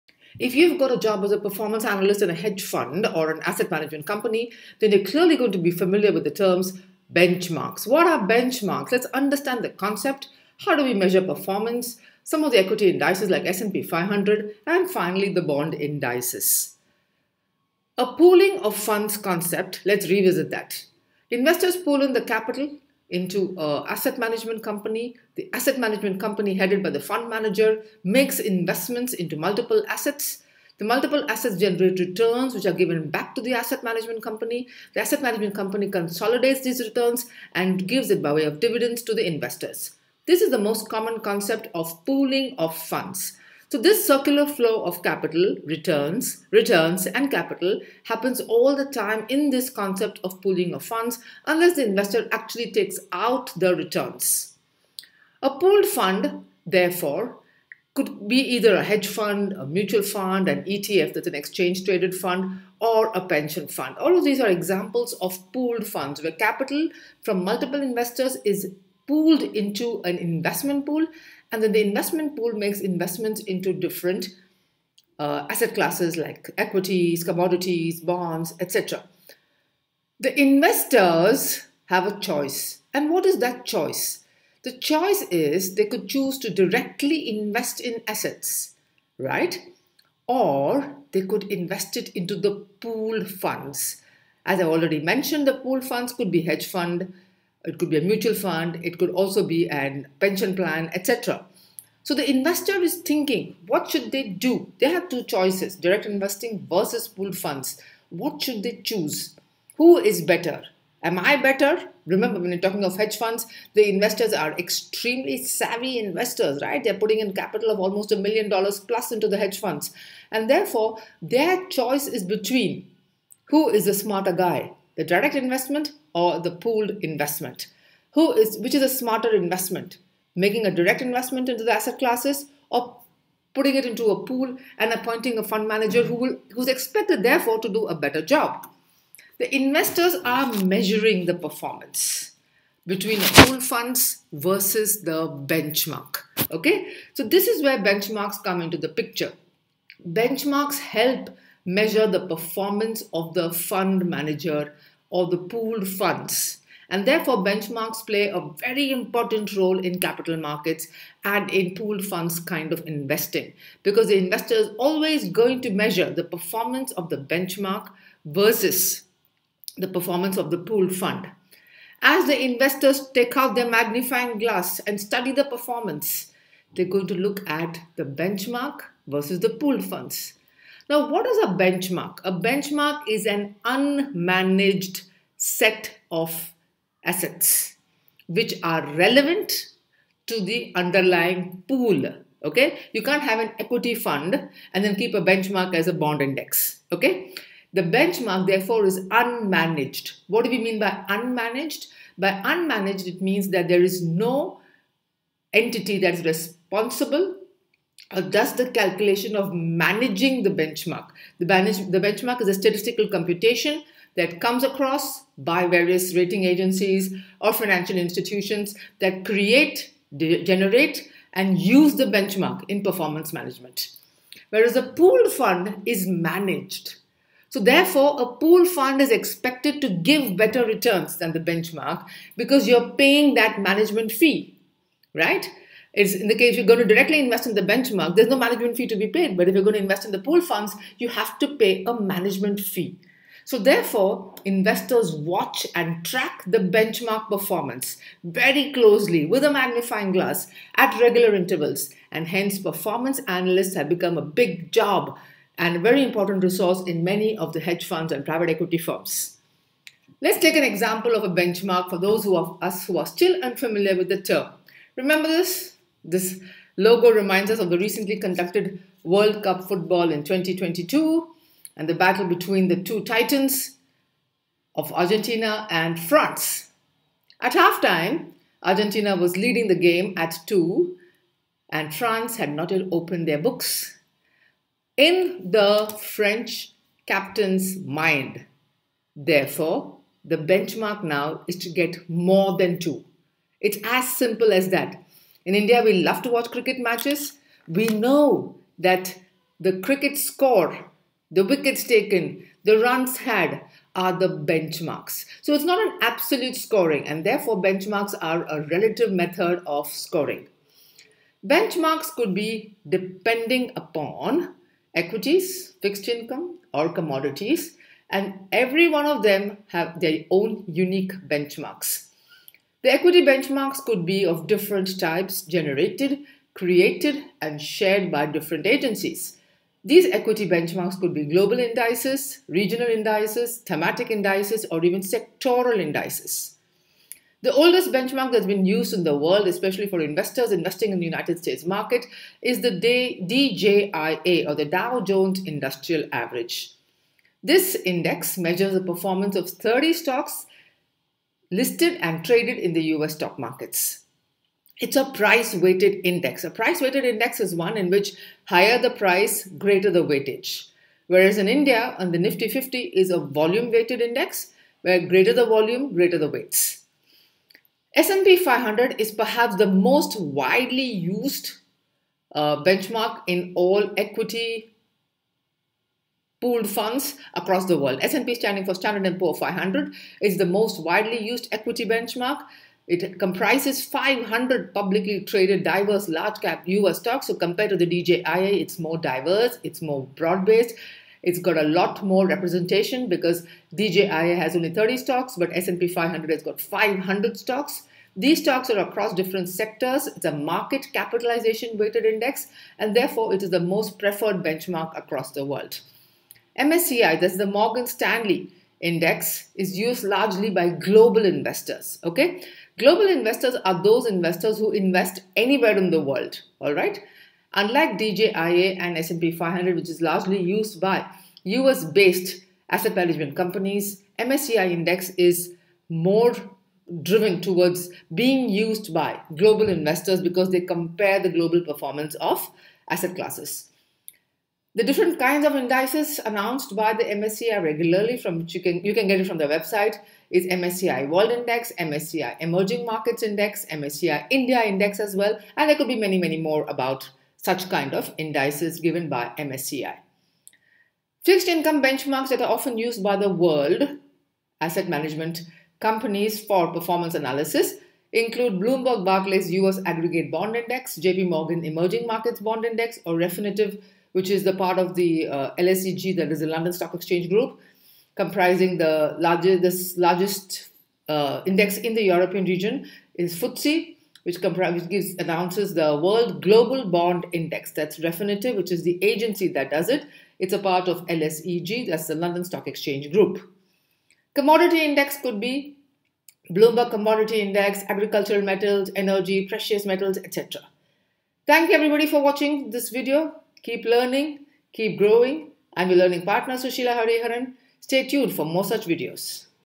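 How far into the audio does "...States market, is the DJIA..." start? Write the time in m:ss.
5:41.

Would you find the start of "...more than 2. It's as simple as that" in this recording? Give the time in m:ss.
4:52.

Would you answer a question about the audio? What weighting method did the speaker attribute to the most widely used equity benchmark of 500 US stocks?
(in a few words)
market capitalization weighted.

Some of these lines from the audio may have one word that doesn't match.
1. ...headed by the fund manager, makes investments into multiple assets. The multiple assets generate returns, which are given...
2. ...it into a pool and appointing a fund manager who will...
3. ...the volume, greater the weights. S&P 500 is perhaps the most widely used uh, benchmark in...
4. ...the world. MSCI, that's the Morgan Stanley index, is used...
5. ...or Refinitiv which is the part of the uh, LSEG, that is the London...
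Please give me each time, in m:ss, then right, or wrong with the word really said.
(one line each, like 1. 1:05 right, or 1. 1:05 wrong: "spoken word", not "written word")
1. 0:26 right
2. 2:13 right
3. 6:05 right
4. 6:45 right
5. 7:43 right.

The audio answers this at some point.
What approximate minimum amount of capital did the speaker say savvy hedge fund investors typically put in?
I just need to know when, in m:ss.
1:58.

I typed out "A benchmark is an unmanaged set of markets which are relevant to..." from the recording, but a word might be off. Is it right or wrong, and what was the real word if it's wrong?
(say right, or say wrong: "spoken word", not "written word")
wrong: "assets", not "markets".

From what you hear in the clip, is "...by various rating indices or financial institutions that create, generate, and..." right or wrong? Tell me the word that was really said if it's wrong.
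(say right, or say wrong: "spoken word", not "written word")
wrong: "agencies", not "indices".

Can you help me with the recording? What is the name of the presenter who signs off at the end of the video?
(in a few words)
Sushila Hariharan.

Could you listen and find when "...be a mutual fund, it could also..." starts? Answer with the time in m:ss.
1:37.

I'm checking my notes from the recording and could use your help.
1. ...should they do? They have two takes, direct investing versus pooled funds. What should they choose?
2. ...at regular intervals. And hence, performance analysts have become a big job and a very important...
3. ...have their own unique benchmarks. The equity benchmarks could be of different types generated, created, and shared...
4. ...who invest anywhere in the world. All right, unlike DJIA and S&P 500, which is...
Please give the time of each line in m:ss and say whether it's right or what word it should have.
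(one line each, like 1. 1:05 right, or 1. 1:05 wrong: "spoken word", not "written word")
1. 1:43 wrong: "choices", not "takes"
2. 4:10 right
3. 5:19 right
4. 6:54 right.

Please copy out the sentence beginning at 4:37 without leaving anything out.
At halftime, Argentina was leading the game at 2 and France had not yet opened their books.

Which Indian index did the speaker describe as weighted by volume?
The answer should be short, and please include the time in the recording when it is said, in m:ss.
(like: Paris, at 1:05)
Nifty 50, at 6:02.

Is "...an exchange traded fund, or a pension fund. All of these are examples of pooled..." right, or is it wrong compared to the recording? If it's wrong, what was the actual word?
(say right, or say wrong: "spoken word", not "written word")
right.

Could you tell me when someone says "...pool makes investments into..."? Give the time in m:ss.
1:12.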